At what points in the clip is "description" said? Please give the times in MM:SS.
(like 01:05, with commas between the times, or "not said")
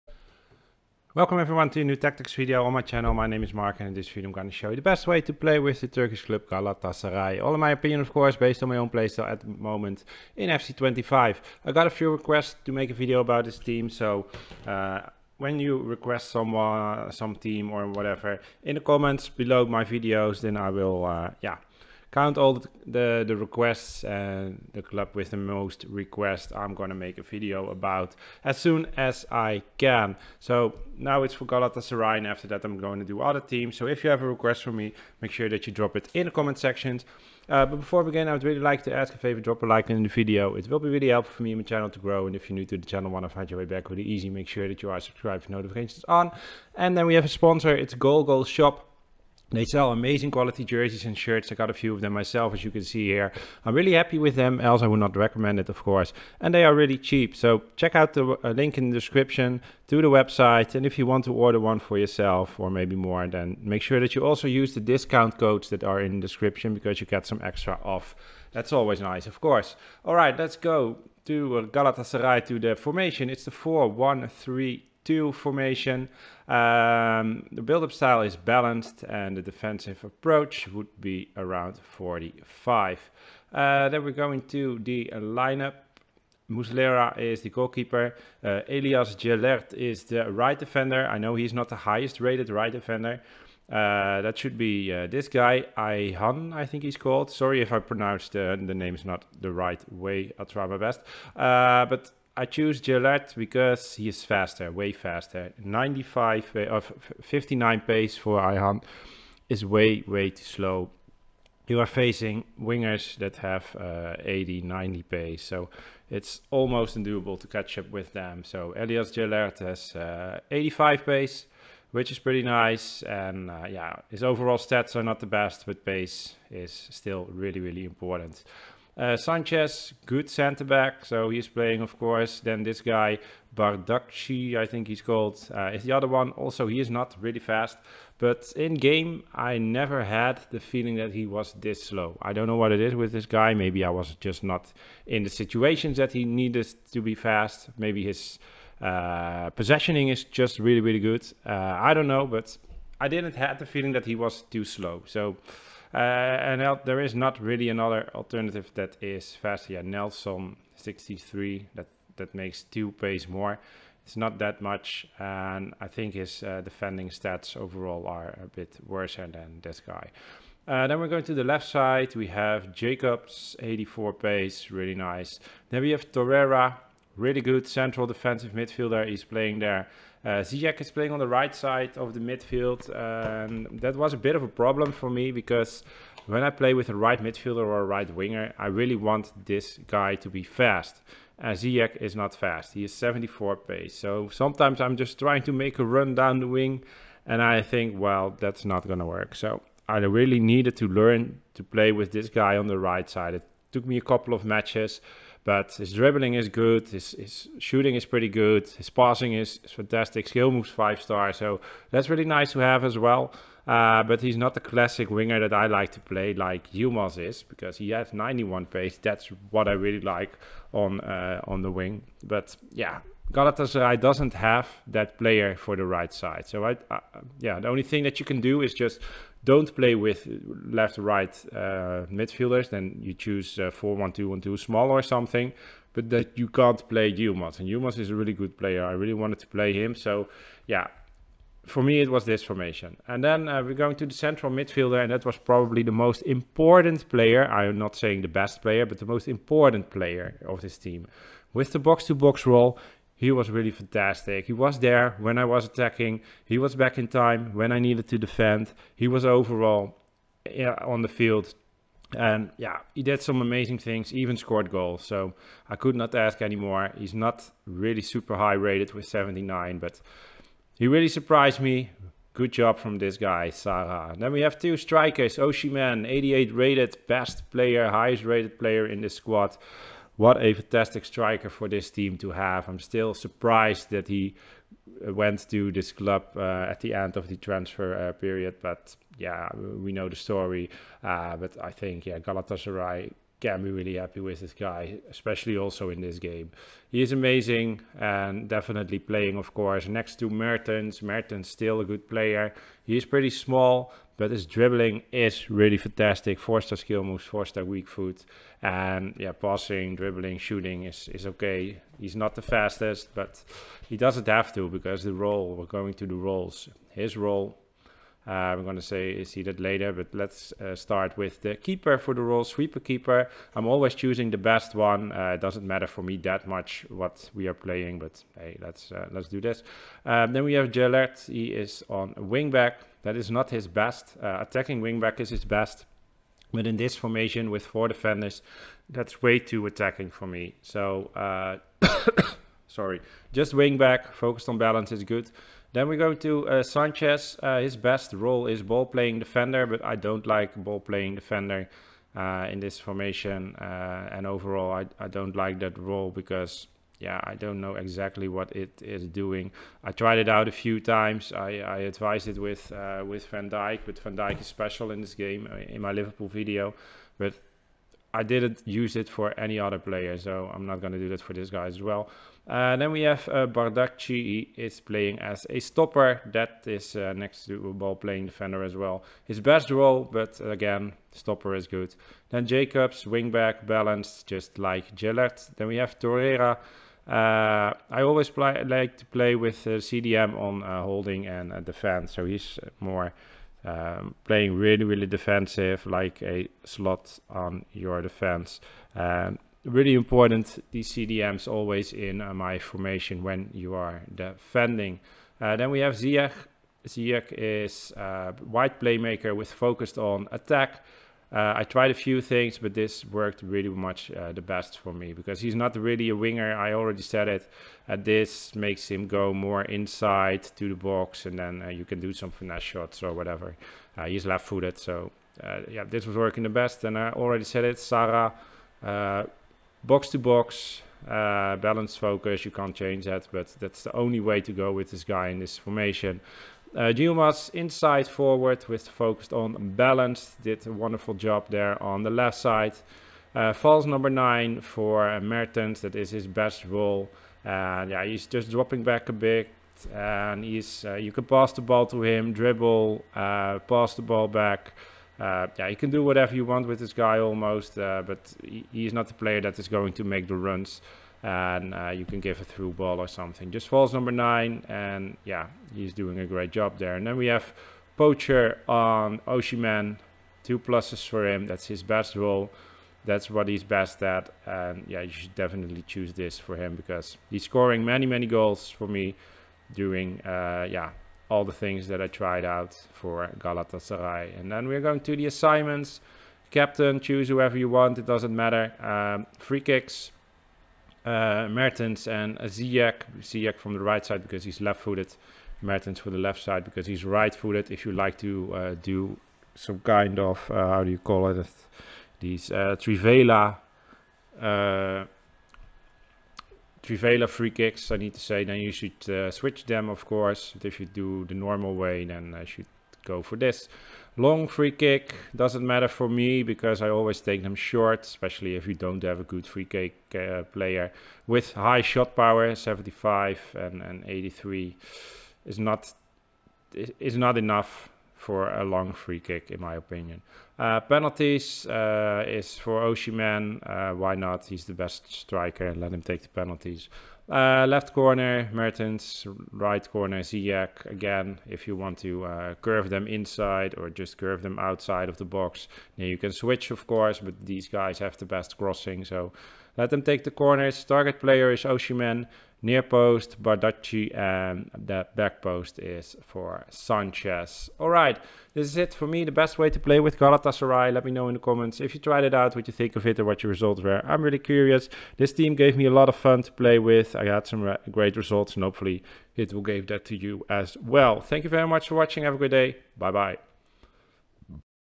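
00:58, 01:06.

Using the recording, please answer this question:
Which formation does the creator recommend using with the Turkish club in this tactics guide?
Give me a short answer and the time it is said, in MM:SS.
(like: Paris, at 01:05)
4-1-3-2, at 01:13.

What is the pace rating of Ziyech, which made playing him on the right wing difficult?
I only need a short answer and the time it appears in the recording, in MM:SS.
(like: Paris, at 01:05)
74, at 03:12.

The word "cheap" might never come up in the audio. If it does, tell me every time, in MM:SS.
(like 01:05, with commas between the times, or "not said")
00:56.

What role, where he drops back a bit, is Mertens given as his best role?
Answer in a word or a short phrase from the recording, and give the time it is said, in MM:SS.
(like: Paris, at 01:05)
False number nine, at 07:23.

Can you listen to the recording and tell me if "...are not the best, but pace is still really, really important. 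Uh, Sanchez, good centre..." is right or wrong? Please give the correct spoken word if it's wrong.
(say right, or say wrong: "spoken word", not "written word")
right.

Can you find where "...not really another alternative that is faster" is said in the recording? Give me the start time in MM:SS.
02:37.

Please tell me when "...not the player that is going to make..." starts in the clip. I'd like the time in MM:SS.
07:38.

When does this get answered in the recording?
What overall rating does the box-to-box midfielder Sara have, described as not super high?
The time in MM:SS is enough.
04:29.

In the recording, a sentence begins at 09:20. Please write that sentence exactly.
Let me know in the comments if you tried it out, what you think of it, or what your results were.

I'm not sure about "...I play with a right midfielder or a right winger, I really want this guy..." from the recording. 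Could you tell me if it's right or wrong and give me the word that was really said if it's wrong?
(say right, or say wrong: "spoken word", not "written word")
right.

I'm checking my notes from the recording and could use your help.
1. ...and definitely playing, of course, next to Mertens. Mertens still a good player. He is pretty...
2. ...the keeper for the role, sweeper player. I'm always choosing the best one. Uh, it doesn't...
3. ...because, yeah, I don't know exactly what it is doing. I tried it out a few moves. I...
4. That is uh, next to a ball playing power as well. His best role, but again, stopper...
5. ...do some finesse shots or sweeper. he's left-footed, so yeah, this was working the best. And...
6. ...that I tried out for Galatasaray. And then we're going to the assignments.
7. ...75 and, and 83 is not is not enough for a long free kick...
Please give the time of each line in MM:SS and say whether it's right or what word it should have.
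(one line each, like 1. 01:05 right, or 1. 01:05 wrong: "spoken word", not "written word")
1. 04:57 right
2. 05:21 wrong: "keeper", not "player"
3. 05:56 wrong: "times", not "moves"
4. 06:16 wrong: "defender", not "power"
5. 07:02 wrong: "whatever", not "sweeper"
6. 08:01 right
7. 08:42 right.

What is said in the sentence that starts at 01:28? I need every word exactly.
Uh, Elias Jelert is the right defender.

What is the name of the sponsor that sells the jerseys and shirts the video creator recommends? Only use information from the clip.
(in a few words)
Goal Goal Shop.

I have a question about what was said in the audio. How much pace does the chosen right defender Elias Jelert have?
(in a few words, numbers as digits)
85.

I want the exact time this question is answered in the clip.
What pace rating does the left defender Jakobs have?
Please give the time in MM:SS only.
02:53.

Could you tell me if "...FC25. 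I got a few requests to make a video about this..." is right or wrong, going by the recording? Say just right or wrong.
right.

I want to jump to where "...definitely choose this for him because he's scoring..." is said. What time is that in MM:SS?
07:55.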